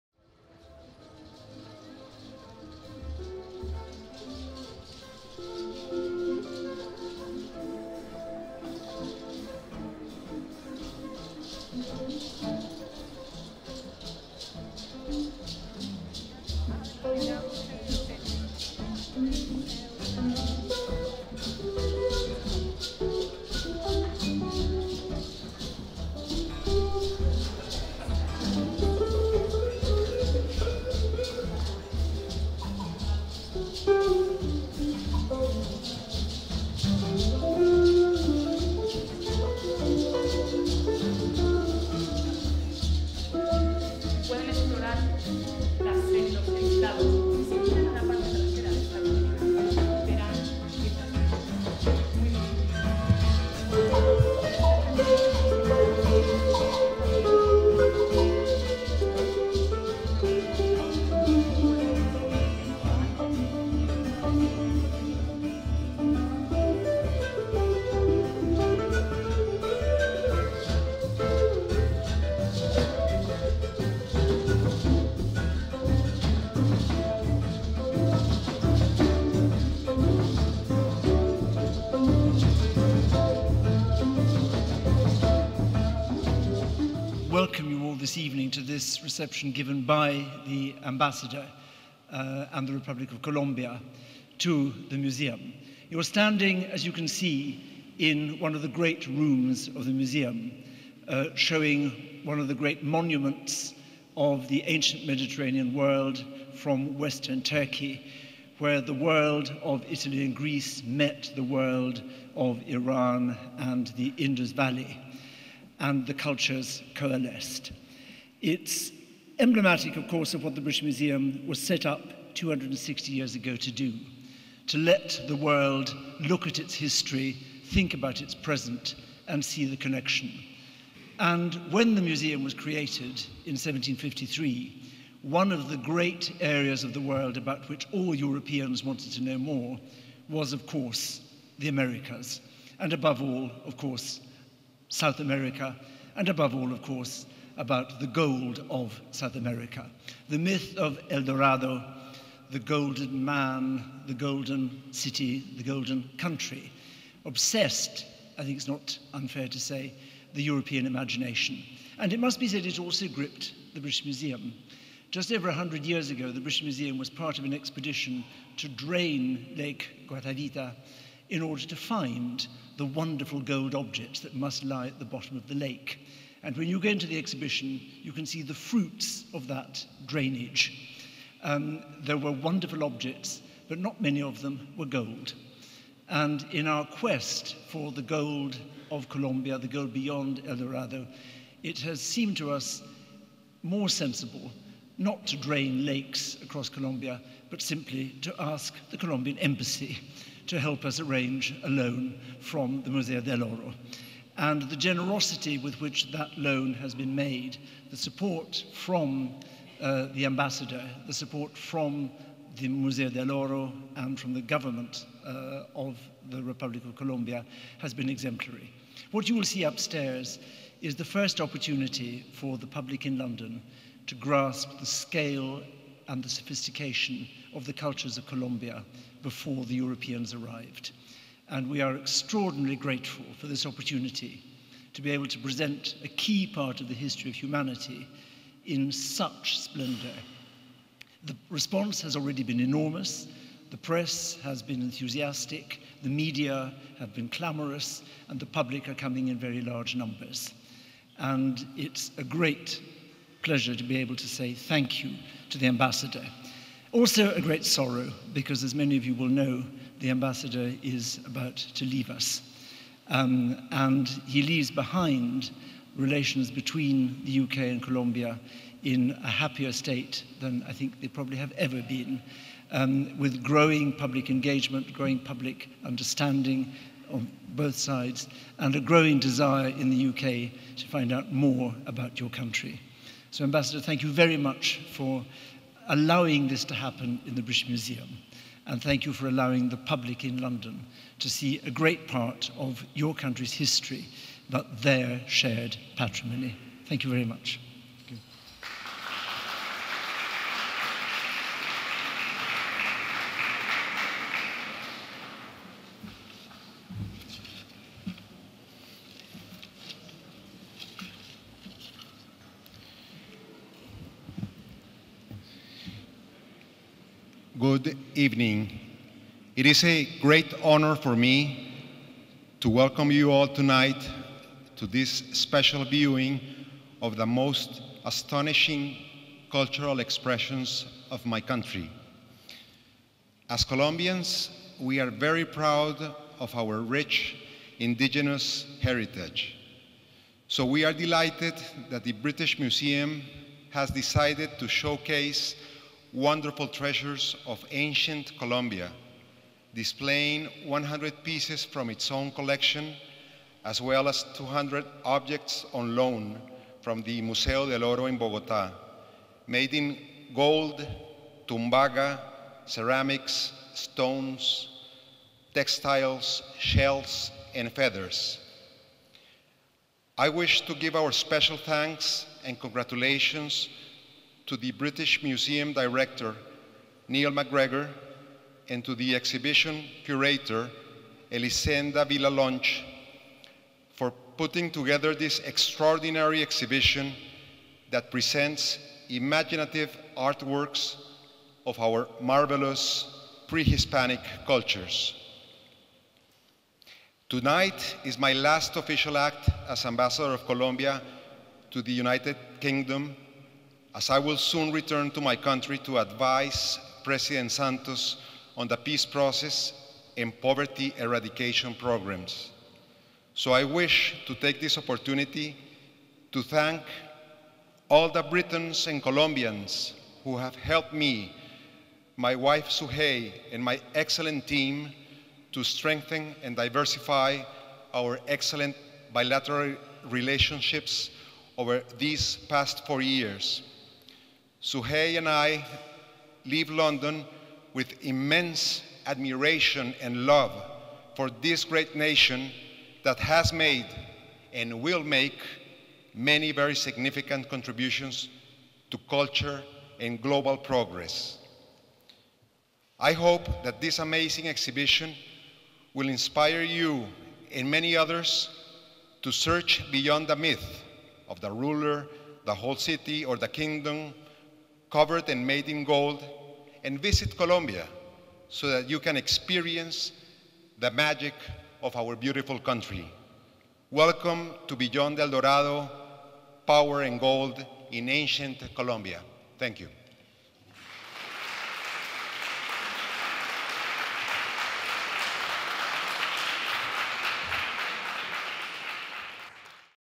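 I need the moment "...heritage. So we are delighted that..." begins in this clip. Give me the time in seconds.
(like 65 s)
338 s.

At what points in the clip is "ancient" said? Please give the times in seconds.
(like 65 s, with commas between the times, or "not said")
104 s, 347 s, 478 s.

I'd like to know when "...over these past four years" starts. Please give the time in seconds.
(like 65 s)
431 s.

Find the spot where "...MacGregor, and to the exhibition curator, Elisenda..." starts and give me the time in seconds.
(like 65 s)
377 s.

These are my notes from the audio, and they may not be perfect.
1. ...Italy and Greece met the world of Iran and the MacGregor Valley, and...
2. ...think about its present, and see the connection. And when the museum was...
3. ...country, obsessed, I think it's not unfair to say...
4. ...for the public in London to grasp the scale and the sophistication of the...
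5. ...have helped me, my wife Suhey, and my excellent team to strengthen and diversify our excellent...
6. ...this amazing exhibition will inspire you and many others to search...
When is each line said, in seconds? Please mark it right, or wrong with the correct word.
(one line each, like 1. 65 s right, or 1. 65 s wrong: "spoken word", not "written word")
1. 109 s wrong: "Indus", not "MacGregor"
2. 127 s right
3. 156 s right
4. 222 s right
5. 420 s right
6. 453 s right.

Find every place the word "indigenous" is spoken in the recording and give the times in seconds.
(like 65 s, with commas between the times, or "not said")
337 s.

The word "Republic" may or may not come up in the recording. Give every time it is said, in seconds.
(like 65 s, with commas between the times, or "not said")
92 s, 216 s.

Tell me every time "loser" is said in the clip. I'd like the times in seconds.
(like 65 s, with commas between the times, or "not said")
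not said.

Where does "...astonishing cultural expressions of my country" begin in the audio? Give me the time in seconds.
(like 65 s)
328 s.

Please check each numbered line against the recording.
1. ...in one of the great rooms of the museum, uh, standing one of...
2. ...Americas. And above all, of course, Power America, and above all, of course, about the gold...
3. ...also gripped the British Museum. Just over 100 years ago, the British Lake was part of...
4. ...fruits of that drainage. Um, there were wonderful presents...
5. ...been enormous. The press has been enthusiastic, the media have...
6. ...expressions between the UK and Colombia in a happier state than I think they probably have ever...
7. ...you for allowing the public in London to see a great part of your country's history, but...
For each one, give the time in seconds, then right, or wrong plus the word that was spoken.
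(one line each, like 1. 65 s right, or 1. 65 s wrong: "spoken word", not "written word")
1. 97 s wrong: "showing", not "standing"
2. 141 s wrong: "South", not "Power"
3. 162 s wrong: "Museum", not "Lake"
4. 178 s wrong: "objects", not "presents"
5. 242 s right
6. 265 s wrong: "relations", not "expressions"
7. 289 s right.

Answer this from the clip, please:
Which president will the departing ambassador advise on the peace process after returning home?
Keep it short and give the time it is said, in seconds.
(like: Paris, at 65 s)
President Santos, at 407 s.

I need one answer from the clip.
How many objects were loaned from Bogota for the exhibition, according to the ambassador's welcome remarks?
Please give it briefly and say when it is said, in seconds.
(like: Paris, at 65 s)
200, at 354 s.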